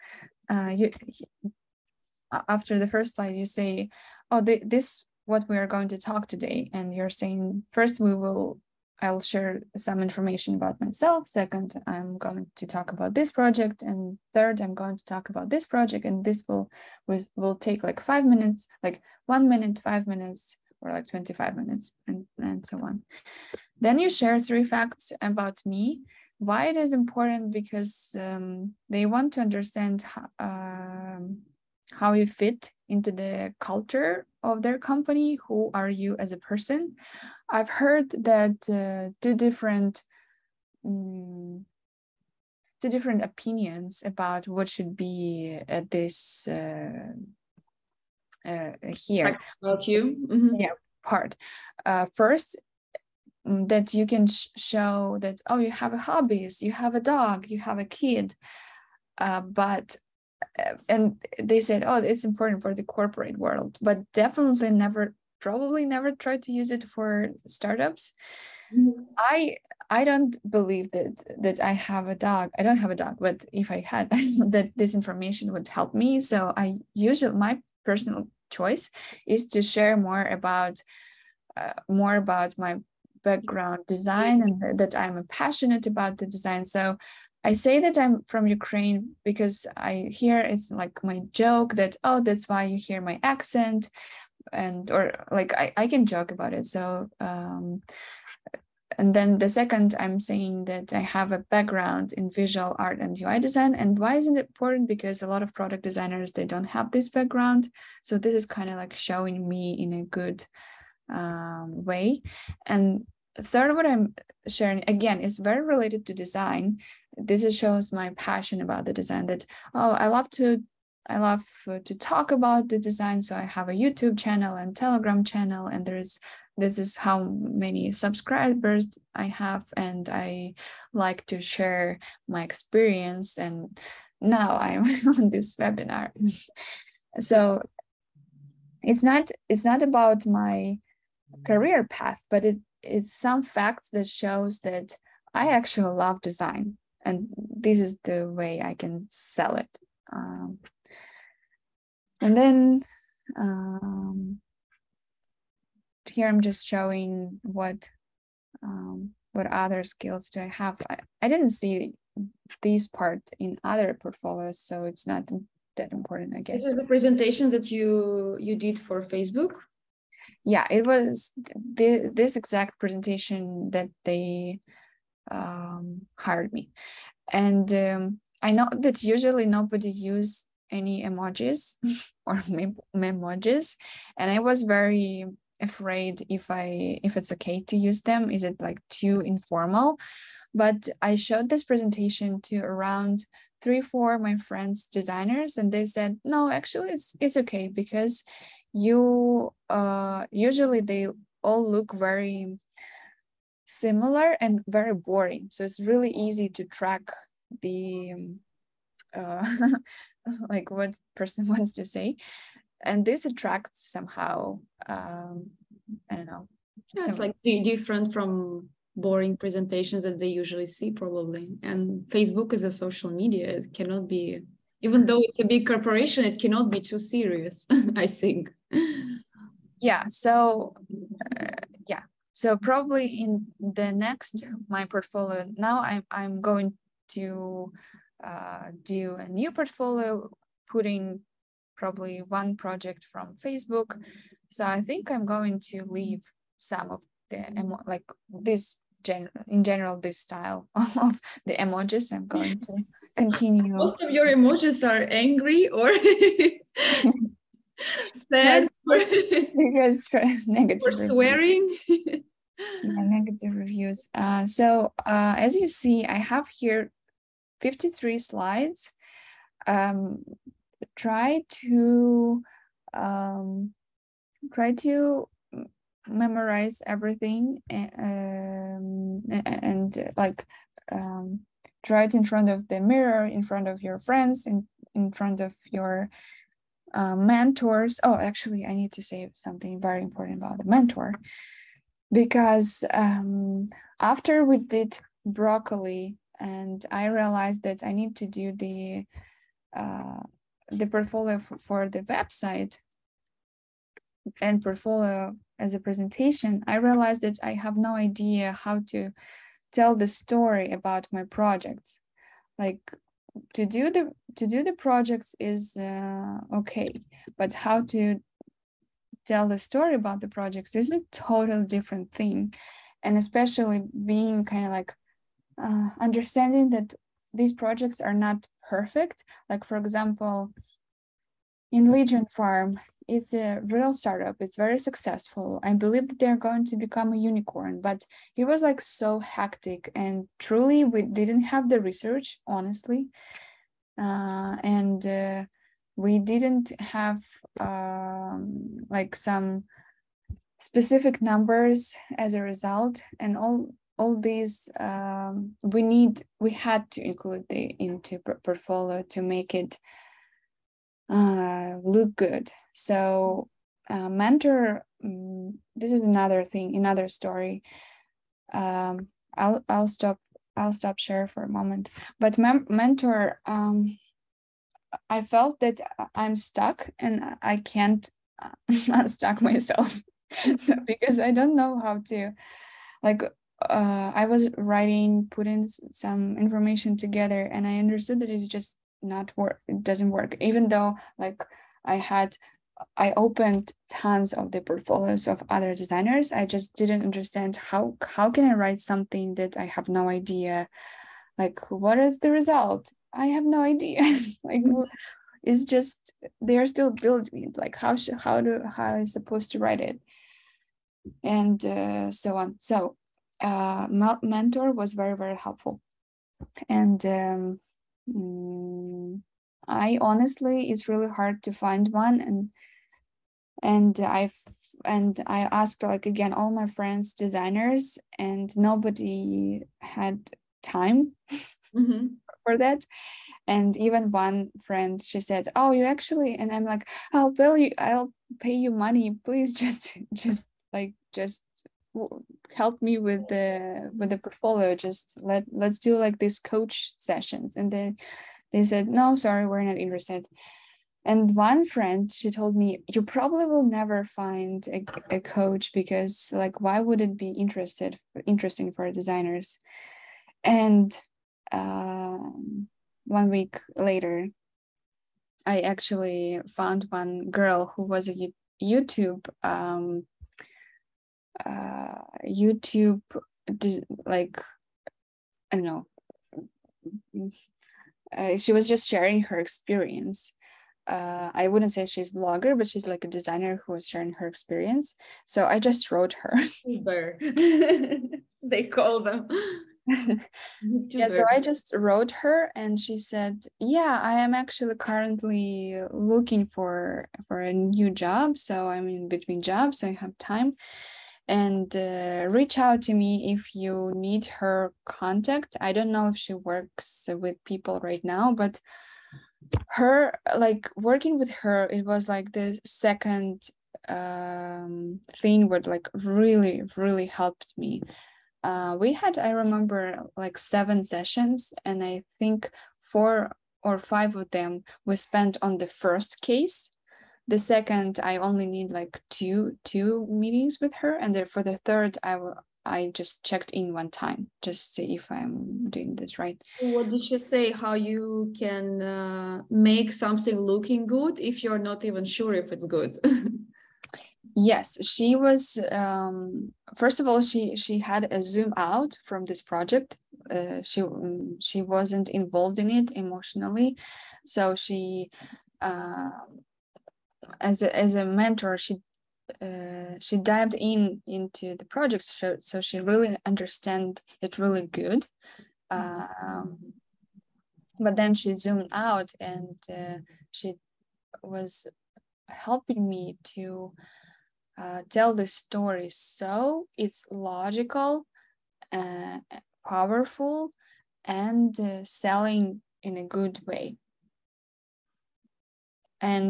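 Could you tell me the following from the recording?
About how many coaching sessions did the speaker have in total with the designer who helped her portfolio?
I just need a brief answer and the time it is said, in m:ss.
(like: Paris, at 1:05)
7, at 8:40.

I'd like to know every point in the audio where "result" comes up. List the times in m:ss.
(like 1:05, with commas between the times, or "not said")
5:52, 6:42.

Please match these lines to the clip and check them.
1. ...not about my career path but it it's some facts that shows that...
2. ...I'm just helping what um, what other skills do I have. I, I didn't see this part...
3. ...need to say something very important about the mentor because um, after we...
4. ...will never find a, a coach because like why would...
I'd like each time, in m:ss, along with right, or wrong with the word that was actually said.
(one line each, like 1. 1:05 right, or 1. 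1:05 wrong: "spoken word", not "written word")
1. 2:19 right
2. 2:36 wrong: "showing", not "helping"
3. 4:48 right
4. 7:33 right.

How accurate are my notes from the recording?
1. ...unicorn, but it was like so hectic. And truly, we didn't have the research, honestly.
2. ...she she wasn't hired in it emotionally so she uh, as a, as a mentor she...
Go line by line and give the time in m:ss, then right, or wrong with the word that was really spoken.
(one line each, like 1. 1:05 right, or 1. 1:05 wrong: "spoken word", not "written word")
1. 5:37 right
2. 9:10 wrong: "involved", not "hired".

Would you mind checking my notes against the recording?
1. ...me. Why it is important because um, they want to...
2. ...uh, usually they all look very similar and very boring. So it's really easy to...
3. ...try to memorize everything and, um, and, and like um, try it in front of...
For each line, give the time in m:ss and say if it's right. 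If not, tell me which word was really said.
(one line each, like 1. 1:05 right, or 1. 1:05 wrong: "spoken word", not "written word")
1. 0:25 right
2. 3:19 right
3. 4:34 right.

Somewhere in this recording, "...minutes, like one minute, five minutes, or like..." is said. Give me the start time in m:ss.
0:18.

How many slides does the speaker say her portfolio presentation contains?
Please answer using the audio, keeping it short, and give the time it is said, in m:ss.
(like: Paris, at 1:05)
53, at 4:27.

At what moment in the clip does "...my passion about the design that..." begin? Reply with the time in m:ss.
1:57.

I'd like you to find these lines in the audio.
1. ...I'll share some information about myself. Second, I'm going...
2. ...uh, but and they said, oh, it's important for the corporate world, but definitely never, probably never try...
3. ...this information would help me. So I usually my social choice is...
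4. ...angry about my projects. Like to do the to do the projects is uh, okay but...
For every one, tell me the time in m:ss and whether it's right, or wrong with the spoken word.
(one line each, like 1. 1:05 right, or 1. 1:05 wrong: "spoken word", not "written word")
1. 0:09 right
2. 0:59 right
3. 1:14 wrong: "personal", not "social"
4. 5:10 wrong: "story", not "angry".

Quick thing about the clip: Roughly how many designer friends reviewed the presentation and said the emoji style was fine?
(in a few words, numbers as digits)
3 or 4.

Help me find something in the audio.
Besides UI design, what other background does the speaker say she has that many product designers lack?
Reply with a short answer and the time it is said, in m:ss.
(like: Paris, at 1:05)
visual art, at 1:42.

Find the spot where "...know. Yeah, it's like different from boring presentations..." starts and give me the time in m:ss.
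3:36.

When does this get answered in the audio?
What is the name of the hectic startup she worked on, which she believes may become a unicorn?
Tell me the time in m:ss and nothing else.
5:31.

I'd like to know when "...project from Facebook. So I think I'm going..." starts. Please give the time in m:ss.
4:02.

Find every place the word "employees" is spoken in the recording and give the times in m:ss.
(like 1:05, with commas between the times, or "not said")
not said.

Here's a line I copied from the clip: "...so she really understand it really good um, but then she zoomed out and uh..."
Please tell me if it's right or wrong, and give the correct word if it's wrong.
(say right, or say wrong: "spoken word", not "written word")
right.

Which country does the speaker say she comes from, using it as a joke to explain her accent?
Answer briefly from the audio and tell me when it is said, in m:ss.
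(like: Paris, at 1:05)
Ukraine, at 1:28.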